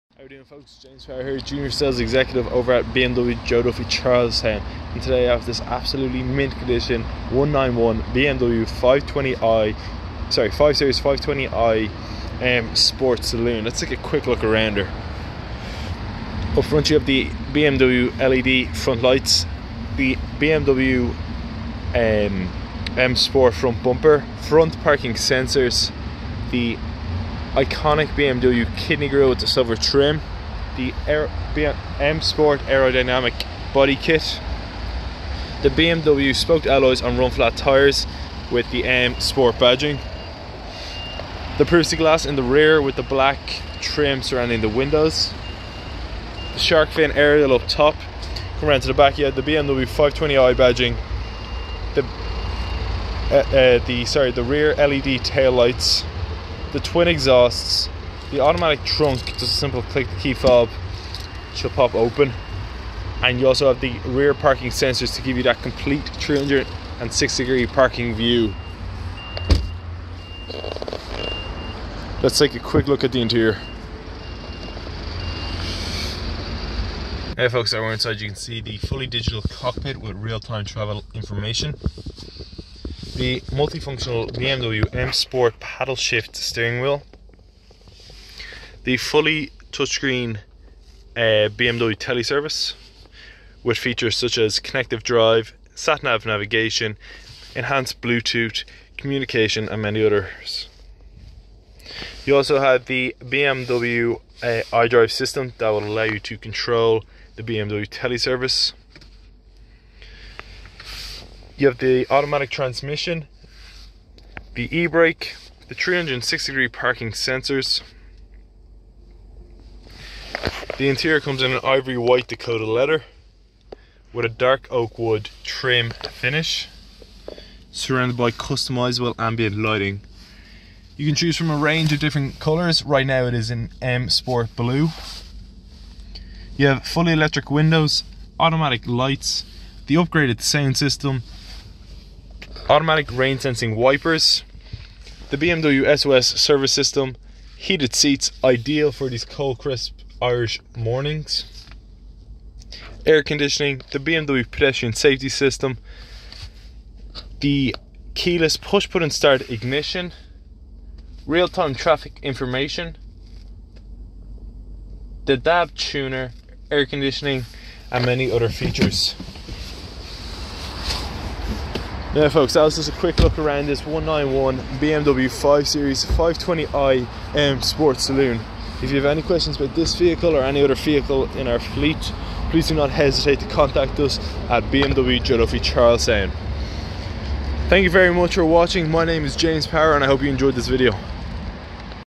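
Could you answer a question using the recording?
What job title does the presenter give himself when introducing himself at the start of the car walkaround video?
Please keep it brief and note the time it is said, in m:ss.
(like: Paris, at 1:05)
Junior Sales Executive, at 0:01.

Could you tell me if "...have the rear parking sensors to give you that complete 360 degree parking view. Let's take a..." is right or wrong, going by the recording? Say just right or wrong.
right.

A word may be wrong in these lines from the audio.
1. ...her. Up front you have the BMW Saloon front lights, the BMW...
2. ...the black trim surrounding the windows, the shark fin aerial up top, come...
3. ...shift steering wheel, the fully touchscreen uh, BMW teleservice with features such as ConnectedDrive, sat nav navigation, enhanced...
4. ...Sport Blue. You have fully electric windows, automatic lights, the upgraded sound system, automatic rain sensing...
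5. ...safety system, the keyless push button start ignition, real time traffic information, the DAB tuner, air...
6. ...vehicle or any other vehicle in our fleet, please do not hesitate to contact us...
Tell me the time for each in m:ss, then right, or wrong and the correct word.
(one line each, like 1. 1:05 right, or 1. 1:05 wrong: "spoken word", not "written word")
1. 0:14 wrong: "LED", not "Saloon"
2. 0:42 right
3. 1:25 right
4. 2:14 right
5. 2:34 right
6. 2:59 right.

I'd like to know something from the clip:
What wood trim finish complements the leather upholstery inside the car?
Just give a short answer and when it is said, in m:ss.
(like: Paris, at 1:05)
Dark oak, at 2:04.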